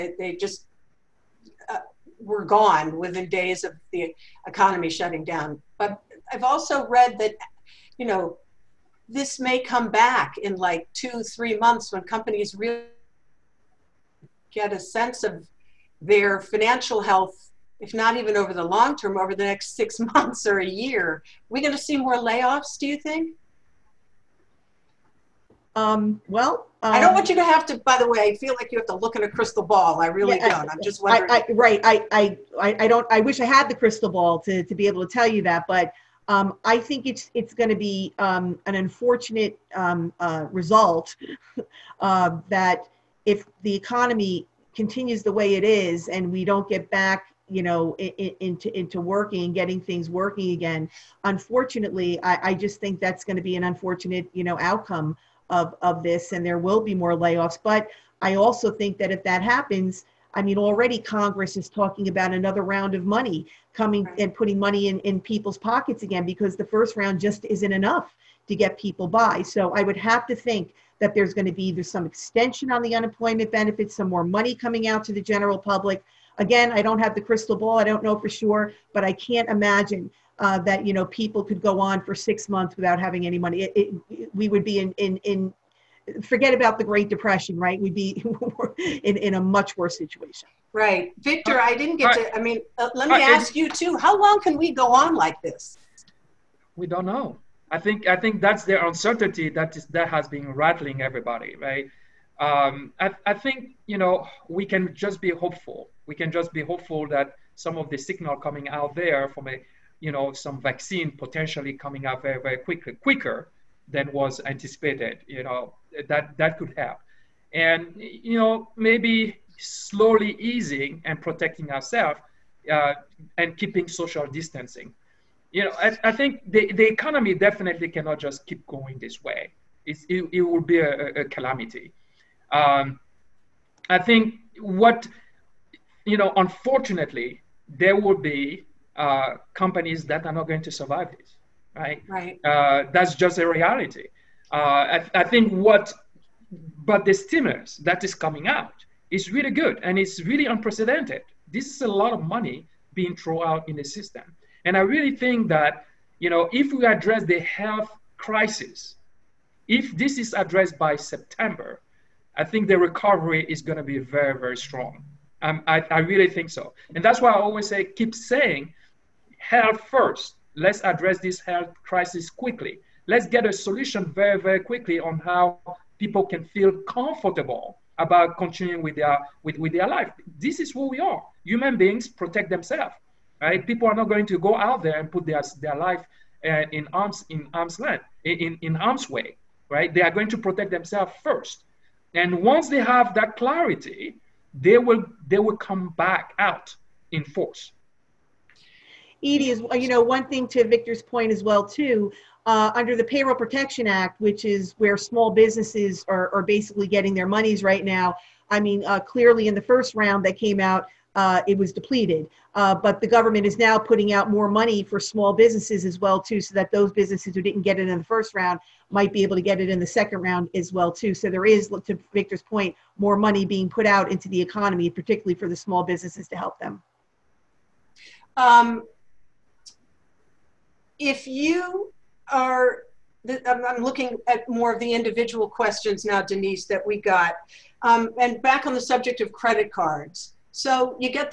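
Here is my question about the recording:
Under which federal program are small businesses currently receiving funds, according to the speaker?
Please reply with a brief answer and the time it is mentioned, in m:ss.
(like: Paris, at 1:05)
Payroll Protection Act, at 3:23.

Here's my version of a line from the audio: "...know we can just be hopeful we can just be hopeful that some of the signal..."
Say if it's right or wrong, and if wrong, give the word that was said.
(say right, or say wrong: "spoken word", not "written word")
right.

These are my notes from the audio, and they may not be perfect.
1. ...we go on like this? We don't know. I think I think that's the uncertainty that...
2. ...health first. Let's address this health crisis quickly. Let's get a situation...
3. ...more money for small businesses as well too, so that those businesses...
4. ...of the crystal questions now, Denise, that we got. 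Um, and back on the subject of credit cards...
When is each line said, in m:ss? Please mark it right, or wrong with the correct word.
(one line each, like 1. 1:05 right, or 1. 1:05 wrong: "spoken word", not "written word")
1. 1:34 right
2. 2:49 wrong: "solution", not "situation"
3. 3:34 right
4. 3:54 wrong: "individual", not "crystal".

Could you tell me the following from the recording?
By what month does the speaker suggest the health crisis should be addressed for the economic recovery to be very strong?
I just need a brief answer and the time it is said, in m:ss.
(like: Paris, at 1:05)
September, at 2:40.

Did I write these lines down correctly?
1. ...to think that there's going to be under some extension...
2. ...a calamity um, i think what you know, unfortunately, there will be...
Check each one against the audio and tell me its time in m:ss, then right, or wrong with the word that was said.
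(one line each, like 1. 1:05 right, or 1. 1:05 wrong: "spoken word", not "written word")
1. 1:10 wrong: "either", not "under"
2. 2:11 right.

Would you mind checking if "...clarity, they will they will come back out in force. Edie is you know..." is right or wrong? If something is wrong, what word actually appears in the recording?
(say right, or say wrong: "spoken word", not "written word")
right.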